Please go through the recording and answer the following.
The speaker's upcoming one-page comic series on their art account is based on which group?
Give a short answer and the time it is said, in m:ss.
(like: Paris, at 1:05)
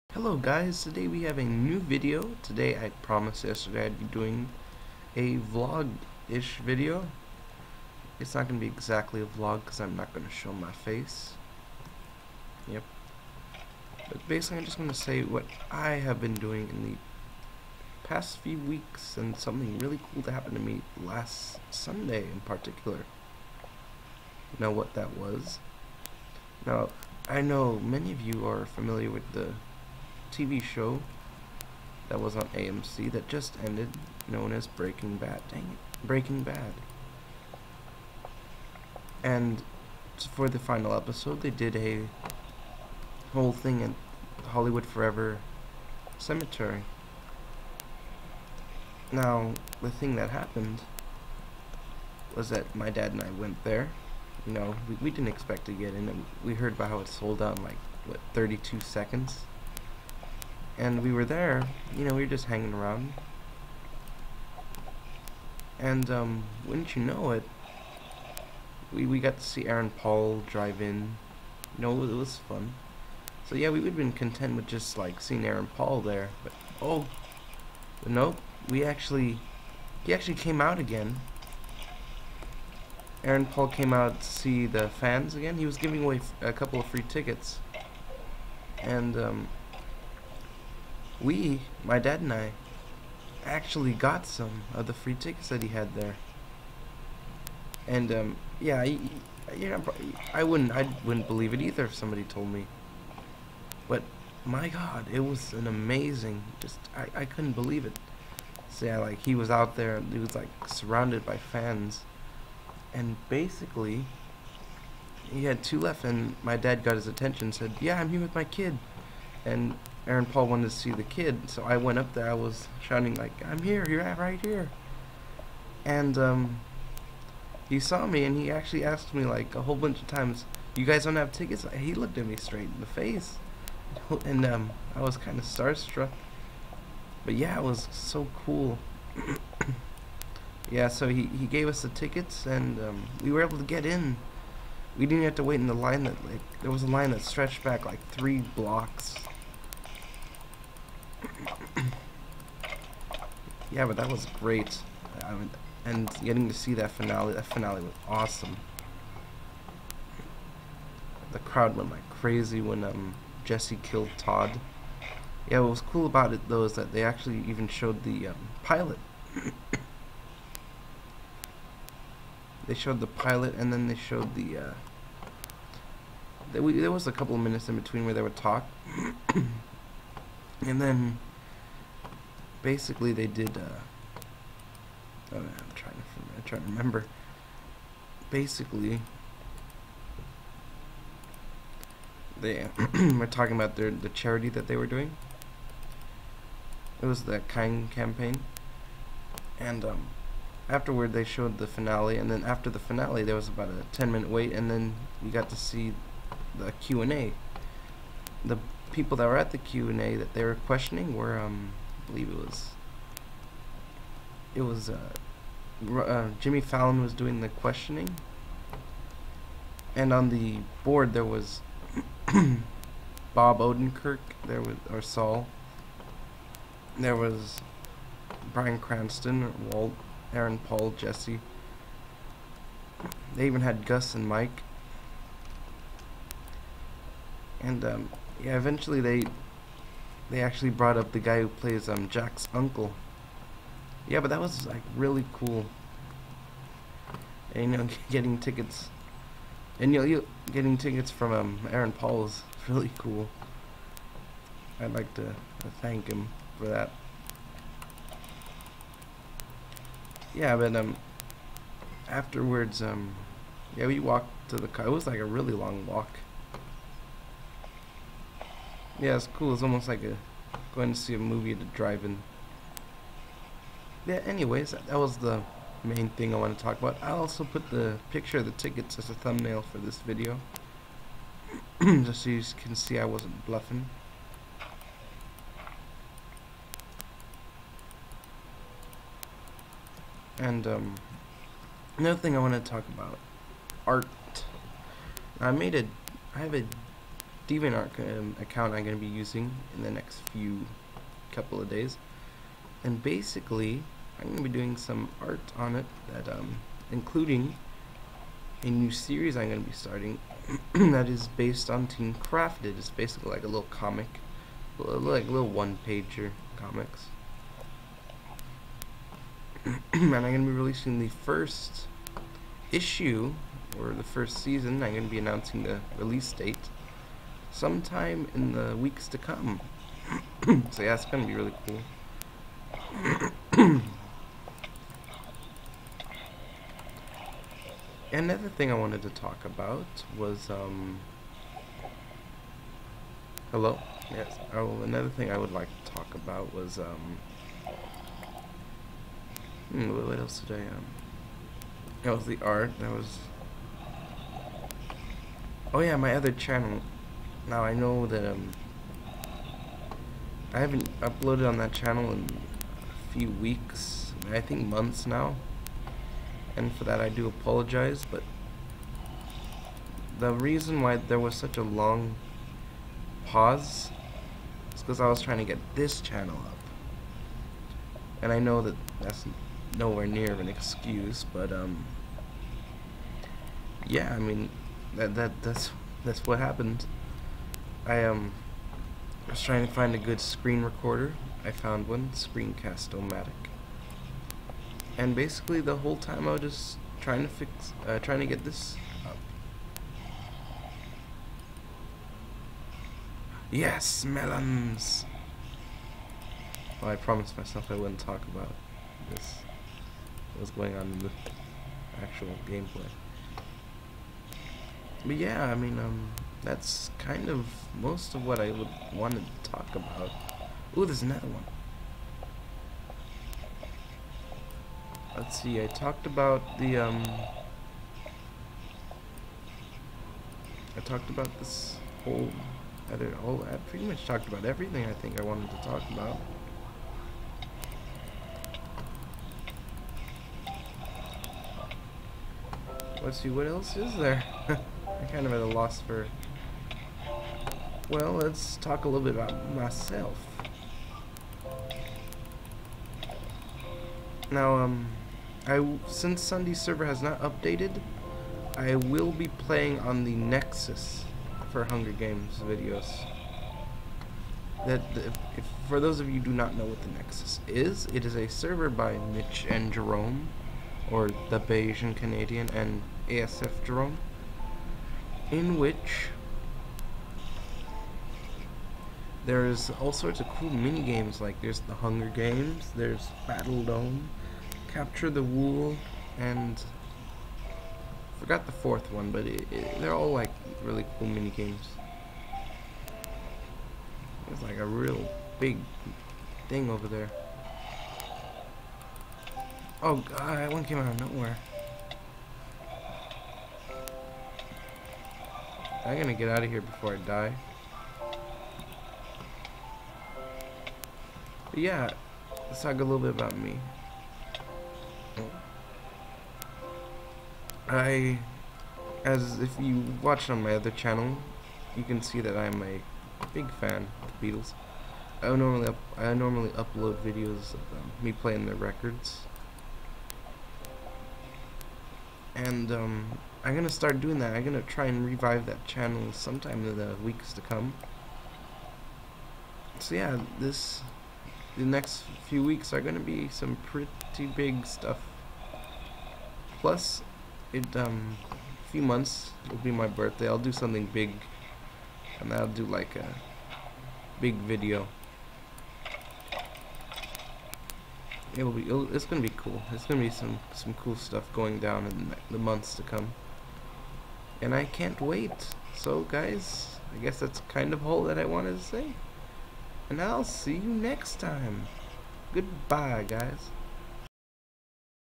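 Team Crafted, at 5:11.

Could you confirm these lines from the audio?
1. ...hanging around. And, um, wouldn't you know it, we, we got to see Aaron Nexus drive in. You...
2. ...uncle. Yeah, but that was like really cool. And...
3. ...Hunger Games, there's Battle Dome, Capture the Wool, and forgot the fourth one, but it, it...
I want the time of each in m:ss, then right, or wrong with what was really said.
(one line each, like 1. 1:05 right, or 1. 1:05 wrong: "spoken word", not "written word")
1. 1:02 wrong: "Paul", not "Nexus"
2. 4:02 right
3. 8:01 right.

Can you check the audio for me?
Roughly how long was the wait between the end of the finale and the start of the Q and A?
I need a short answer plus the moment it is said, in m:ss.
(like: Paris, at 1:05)
10 minutes, at 3:23.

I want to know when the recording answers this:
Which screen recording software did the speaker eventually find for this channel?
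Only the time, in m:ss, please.
6:32.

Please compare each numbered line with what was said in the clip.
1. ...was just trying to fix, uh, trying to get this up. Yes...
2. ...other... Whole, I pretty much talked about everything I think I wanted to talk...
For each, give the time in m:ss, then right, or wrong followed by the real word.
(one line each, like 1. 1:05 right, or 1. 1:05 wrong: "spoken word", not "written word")
1. 6:36 right
2. 7:12 right.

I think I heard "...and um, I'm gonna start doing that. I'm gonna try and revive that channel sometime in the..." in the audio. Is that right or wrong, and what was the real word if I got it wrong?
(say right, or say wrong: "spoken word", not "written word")
right.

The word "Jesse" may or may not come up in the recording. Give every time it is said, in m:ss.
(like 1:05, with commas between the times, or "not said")
2:43, 3:50.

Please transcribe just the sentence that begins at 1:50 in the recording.
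He was like surrounded by fans, and basically, he had two left.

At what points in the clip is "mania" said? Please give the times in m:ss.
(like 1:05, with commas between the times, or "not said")
not said.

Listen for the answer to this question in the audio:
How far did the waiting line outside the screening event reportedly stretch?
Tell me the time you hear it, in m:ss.
2:28.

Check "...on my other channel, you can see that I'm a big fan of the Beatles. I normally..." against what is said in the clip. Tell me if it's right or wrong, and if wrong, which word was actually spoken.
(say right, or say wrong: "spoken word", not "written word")
right.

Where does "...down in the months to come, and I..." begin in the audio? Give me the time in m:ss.
9:21.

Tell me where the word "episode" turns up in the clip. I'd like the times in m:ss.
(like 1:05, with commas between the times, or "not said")
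0:40.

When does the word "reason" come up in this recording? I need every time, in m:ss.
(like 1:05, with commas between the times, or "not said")
6:10.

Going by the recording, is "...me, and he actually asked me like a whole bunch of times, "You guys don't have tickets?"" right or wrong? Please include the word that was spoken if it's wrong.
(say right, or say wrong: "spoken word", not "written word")
right.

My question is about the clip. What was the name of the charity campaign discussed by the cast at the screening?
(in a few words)
Kind Campaign.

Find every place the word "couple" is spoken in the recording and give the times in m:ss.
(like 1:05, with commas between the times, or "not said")
1:26, 2:57, 5:01.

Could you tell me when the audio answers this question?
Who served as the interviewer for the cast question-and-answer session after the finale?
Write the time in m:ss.
3:36.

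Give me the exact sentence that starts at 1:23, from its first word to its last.
Aaron Paul came out to see the fans again.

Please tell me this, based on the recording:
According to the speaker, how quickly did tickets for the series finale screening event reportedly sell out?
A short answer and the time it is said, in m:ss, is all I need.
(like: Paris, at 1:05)
32 seconds, at 0:58.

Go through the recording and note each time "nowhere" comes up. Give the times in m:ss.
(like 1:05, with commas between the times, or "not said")
6:19, 8:21.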